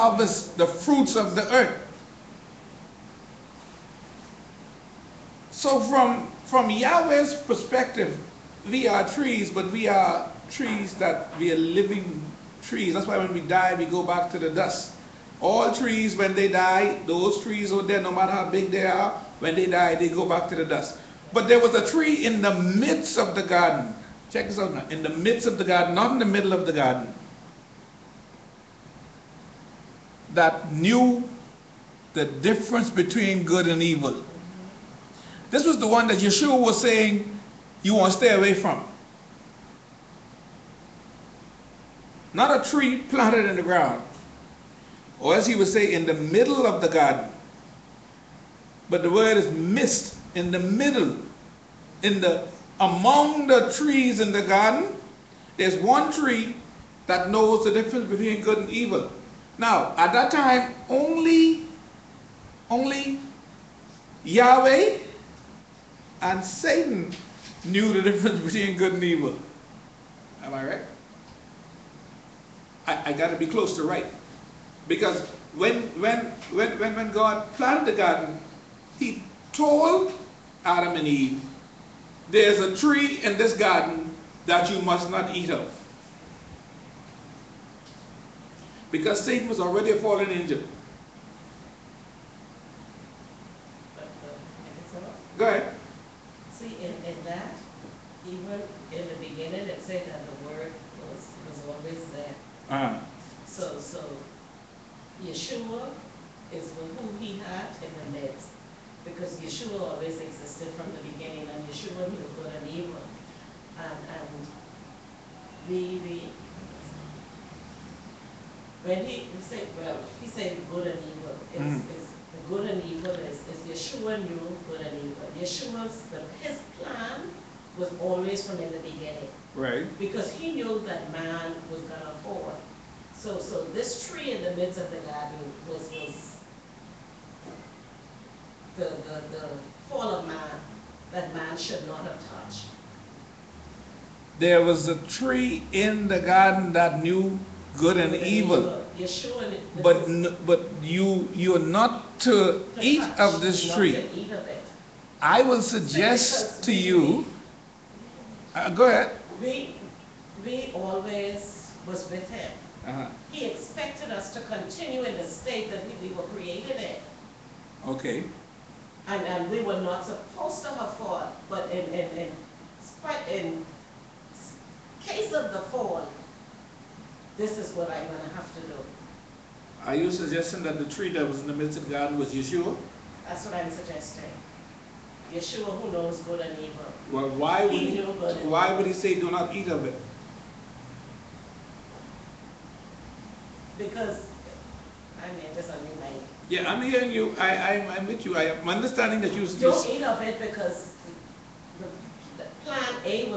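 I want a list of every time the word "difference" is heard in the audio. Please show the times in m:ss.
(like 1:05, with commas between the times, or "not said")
0:32, 0:57, 1:08.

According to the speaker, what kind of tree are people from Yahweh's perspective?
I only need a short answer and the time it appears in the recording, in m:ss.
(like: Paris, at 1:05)
Living trees, at 0:11.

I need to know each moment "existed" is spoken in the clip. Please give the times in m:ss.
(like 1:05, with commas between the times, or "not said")
1:50.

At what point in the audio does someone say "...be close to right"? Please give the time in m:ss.
1:13.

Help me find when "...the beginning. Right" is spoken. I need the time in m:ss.
2:08.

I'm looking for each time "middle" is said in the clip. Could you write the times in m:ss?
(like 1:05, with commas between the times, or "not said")
0:26, 0:46, 0:50.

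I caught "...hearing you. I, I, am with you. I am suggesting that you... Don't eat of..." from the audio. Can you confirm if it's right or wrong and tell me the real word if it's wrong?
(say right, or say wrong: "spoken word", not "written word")
wrong: "understanding", not "suggesting".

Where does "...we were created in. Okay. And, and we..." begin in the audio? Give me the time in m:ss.
2:46.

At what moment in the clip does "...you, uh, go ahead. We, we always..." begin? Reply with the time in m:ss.
2:36.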